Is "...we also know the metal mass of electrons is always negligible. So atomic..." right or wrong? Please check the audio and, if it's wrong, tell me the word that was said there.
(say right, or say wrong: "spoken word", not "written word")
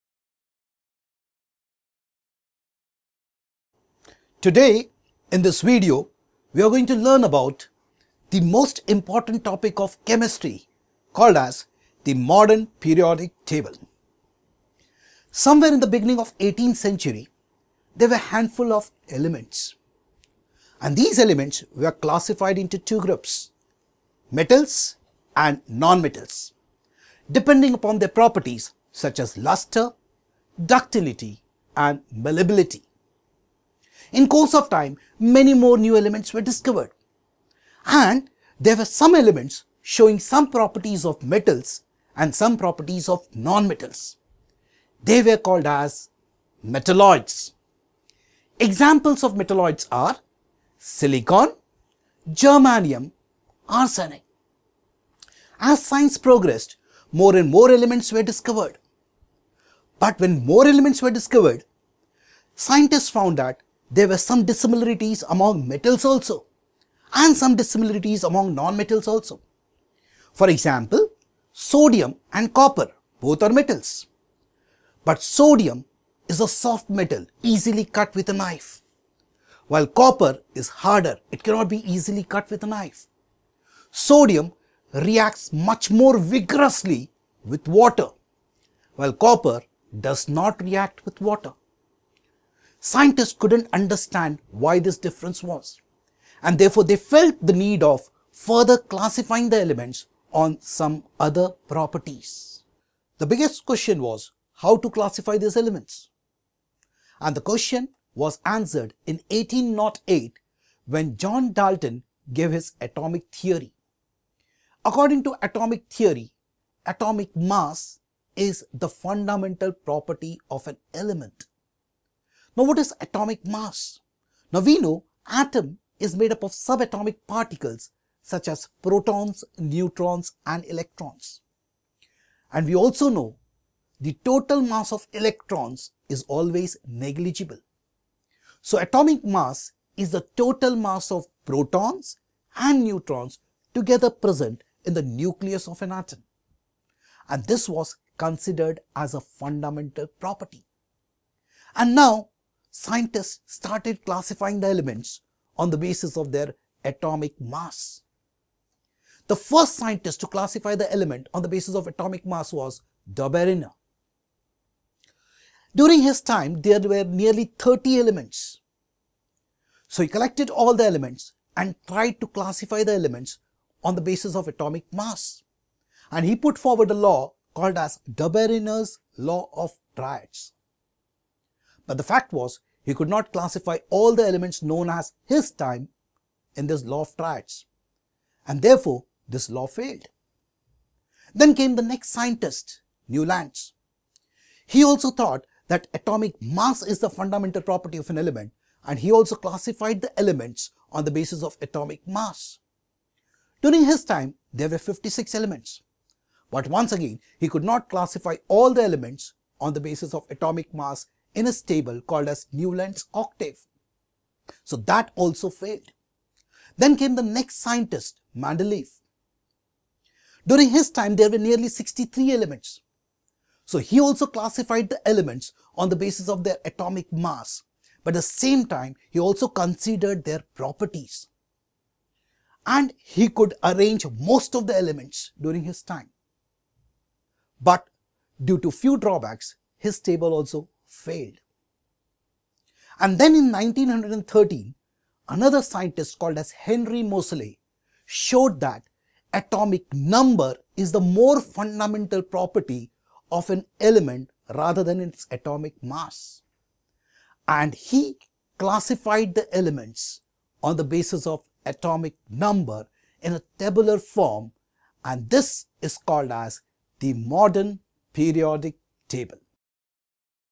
wrong: "total", not "metal".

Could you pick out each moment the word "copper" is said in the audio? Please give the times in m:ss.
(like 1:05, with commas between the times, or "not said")
1:12, 1:19, 1:29.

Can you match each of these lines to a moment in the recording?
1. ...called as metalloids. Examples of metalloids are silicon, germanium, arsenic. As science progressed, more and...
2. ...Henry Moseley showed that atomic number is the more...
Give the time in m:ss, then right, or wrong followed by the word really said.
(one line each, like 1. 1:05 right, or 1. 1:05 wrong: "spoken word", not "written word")
1. 0:45 right
2. 4:06 right.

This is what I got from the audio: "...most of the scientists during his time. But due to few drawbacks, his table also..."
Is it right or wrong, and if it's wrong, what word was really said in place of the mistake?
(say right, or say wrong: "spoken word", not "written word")
wrong: "elements", not "scientists".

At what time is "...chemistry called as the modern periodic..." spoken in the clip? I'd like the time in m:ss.
0:10.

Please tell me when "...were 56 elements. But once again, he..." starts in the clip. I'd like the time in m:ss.
3:24.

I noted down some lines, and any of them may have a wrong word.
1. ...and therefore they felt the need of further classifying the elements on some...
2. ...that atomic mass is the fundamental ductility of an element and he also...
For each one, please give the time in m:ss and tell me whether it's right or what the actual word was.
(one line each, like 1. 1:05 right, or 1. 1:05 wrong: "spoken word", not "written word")
1. 1:36 right
2. 3:15 wrong: "property", not "ductility".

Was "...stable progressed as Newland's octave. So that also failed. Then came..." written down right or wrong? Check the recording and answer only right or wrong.
wrong.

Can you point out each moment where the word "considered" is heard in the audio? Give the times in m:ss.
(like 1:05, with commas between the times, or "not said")
2:28, 3:49.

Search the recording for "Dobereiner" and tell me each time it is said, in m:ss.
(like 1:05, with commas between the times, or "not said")
2:43, 2:58.